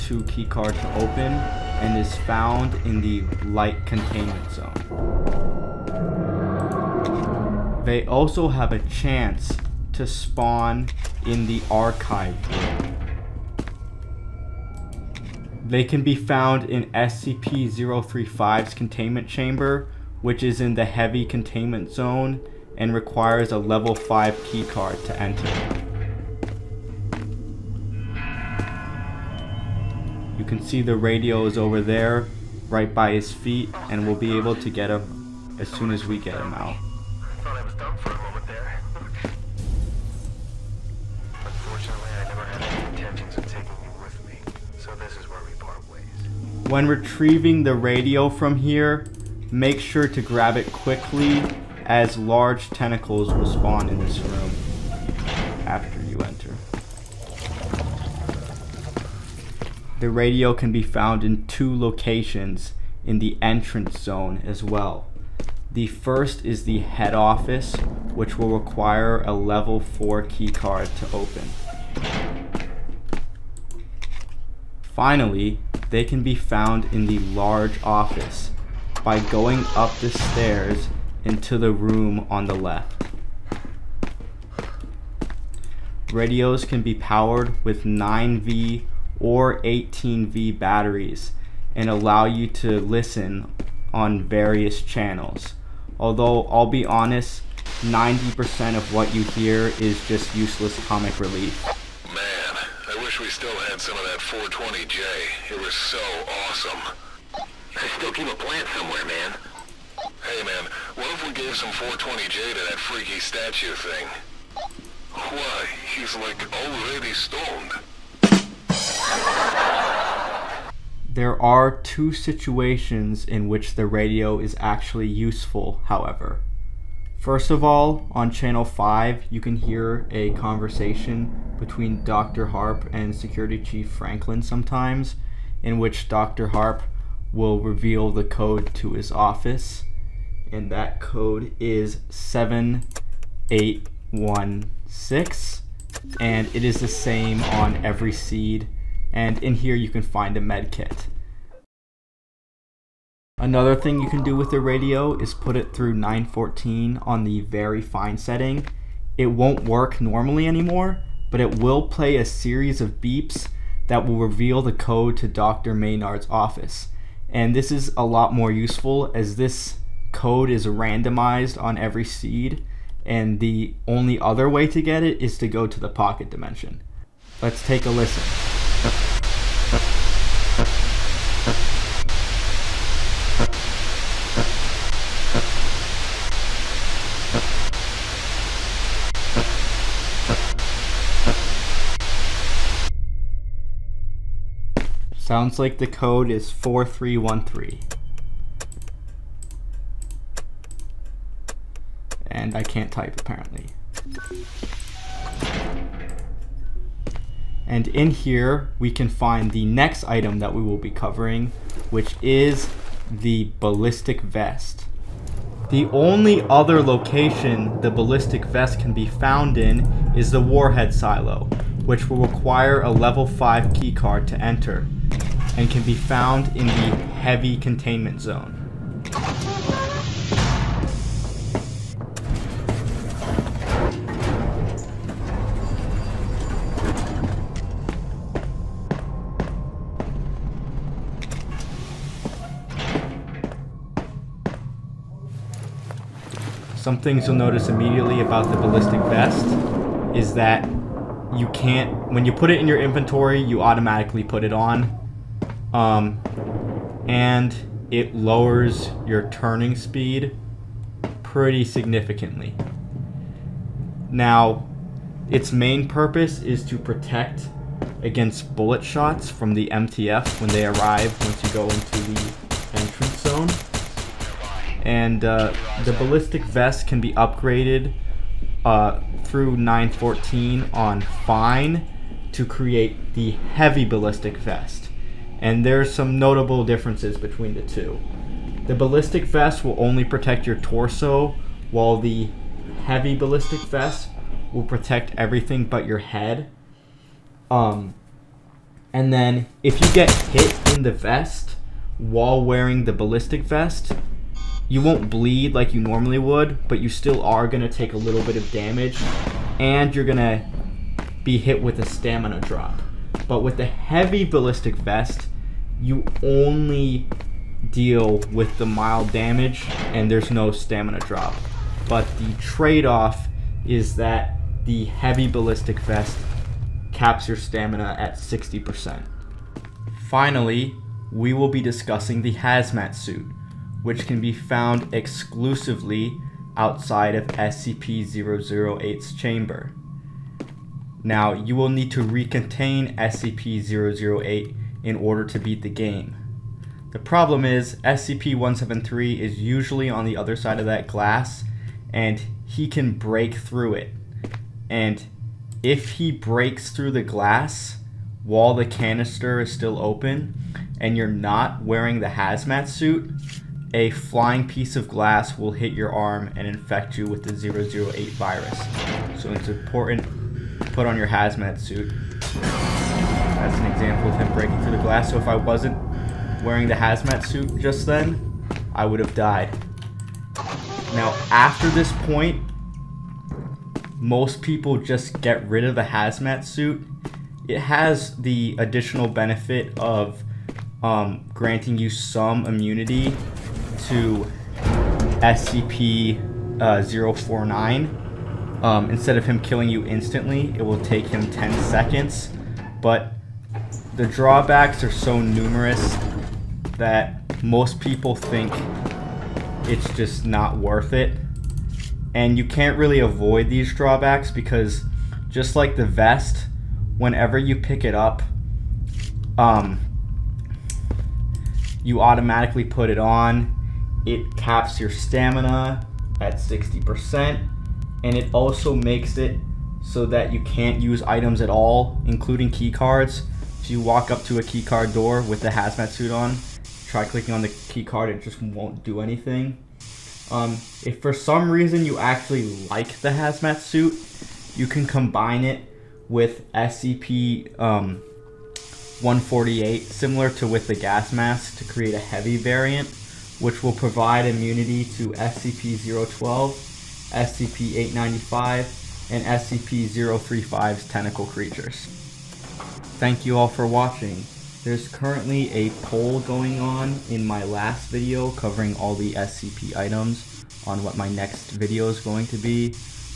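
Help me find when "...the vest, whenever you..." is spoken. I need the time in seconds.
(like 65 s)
415 s.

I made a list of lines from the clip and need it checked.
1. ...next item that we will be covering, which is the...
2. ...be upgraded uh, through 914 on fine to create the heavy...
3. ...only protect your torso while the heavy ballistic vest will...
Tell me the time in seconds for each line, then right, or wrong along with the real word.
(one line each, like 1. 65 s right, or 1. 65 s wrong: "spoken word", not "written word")
1. 209 s right
2. 276 s right
3. 289 s right.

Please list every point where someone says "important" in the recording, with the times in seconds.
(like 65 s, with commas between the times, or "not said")
369 s.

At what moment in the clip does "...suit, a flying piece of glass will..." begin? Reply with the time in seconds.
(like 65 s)
362 s.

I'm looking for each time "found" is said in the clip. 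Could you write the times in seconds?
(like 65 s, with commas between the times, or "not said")
2 s, 16 s, 60 s, 76 s, 219 s, 225 s, 334 s.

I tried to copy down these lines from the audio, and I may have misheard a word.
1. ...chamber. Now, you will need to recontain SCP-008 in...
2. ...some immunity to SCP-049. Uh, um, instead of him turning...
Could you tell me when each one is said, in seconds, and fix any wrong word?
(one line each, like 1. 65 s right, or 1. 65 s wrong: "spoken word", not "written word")
1. 339 s right
2. 391 s wrong: "killing", not "turning".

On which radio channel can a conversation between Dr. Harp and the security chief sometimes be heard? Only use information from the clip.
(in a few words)
5.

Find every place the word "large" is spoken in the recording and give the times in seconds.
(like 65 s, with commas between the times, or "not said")
52 s, 77 s.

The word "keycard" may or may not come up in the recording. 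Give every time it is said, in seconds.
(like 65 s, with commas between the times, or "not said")
0 s, 24 s, 70 s, 223 s.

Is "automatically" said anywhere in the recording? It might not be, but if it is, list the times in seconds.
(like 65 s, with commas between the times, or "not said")
253 s, 422 s.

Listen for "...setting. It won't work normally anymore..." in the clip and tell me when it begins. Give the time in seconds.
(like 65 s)
158 s.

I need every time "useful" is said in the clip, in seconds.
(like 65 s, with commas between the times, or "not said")
125 s, 168 s.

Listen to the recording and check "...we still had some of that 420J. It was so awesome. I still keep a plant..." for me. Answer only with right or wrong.
right.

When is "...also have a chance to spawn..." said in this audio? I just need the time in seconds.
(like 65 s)
8 s.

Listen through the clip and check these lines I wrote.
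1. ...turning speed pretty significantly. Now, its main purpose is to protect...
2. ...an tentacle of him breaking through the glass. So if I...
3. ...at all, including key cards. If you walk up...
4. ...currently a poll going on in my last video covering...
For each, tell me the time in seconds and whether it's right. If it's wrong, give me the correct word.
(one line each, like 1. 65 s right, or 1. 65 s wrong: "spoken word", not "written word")
1. 259 s right
2. 373 s wrong: "example", not "tentacle"
3. 431 s right
4. 464 s right.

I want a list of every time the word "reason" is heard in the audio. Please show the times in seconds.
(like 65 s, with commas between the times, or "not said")
441 s.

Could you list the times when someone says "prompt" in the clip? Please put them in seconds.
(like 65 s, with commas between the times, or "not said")
not said.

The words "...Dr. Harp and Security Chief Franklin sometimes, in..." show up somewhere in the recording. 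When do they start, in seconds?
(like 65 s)
132 s.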